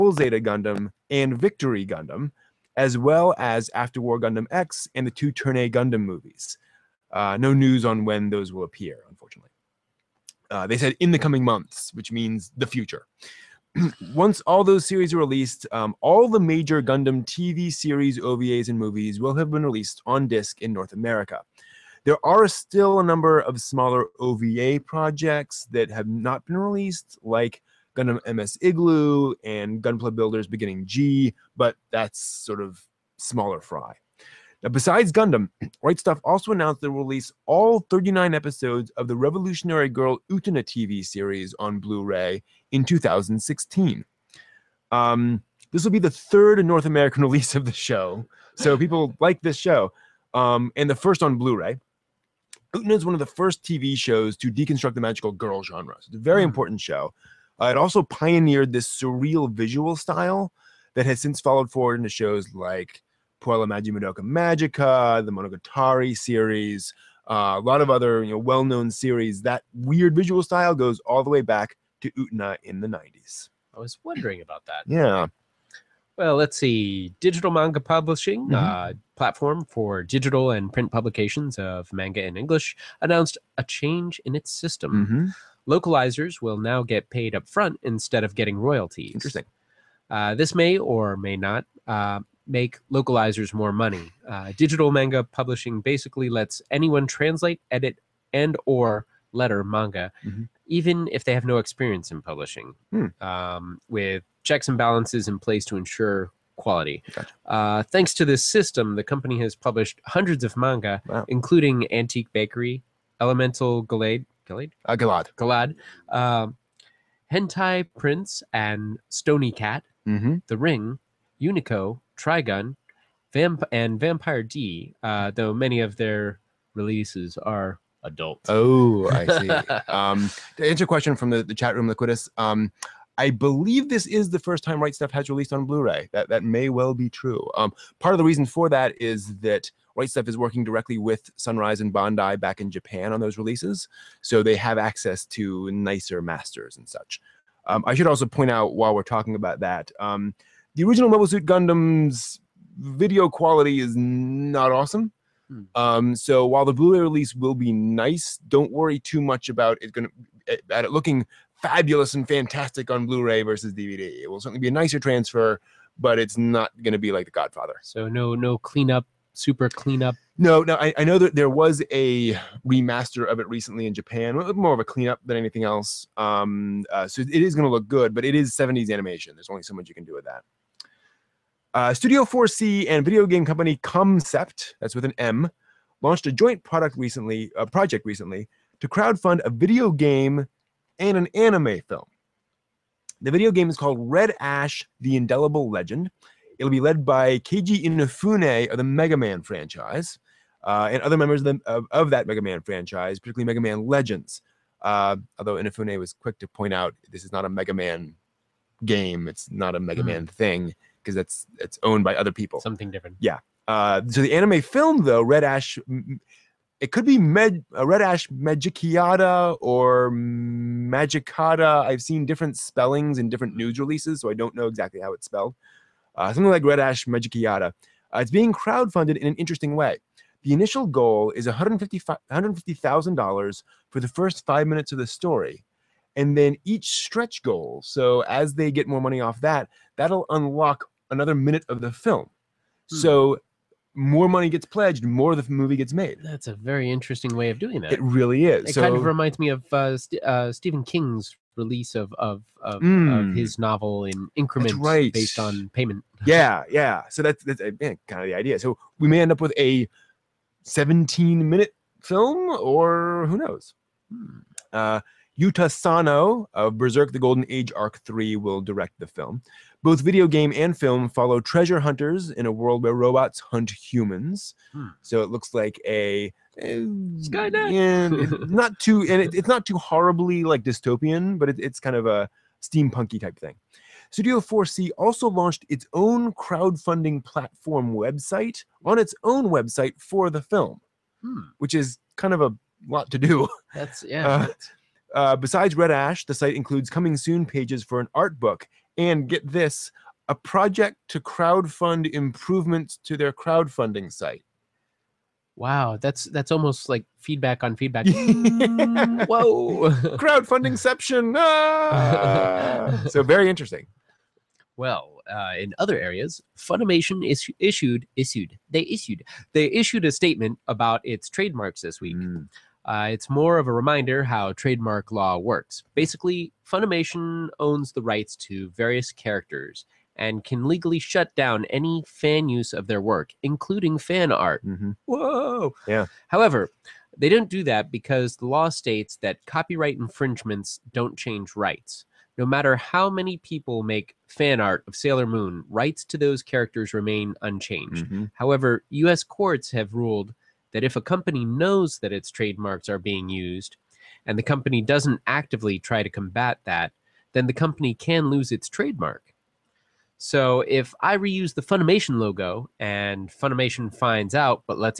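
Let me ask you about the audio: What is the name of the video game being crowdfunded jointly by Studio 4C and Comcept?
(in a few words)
Red Ash: The Indelible Legend.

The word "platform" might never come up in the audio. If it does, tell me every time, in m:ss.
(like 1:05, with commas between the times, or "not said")
1:19, 4:47.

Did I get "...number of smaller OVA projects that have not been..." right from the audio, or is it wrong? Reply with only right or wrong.
right.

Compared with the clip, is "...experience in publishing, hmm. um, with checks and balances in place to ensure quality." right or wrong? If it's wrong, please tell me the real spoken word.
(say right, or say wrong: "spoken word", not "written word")
right.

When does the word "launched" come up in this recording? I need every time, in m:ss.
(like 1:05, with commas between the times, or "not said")
3:06, 4:45.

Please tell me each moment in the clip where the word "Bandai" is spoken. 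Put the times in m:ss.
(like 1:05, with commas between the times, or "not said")
2:21.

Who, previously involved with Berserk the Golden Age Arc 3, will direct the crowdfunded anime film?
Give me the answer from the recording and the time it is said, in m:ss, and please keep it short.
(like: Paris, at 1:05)
Yuta Sano, at 4:25.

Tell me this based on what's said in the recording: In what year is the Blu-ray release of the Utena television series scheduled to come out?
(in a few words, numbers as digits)
2016.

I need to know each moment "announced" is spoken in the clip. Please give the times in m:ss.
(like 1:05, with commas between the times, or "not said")
0:36, 1:23.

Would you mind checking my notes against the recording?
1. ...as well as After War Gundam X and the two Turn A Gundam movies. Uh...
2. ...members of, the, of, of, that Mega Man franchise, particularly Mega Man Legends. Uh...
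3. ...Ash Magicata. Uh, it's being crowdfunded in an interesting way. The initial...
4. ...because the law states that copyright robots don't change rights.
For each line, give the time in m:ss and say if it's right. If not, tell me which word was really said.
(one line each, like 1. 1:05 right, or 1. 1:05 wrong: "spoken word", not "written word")
1. 0:02 right
2. 3:21 right
3. 3:46 right
4. 5:37 wrong: "infringements", not "robots".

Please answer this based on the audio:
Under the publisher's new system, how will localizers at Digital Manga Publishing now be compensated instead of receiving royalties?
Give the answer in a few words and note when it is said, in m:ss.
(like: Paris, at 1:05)
Paid up front, at 1:27.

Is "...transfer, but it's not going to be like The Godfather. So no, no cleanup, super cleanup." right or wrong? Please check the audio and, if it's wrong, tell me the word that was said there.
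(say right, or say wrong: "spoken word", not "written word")
right.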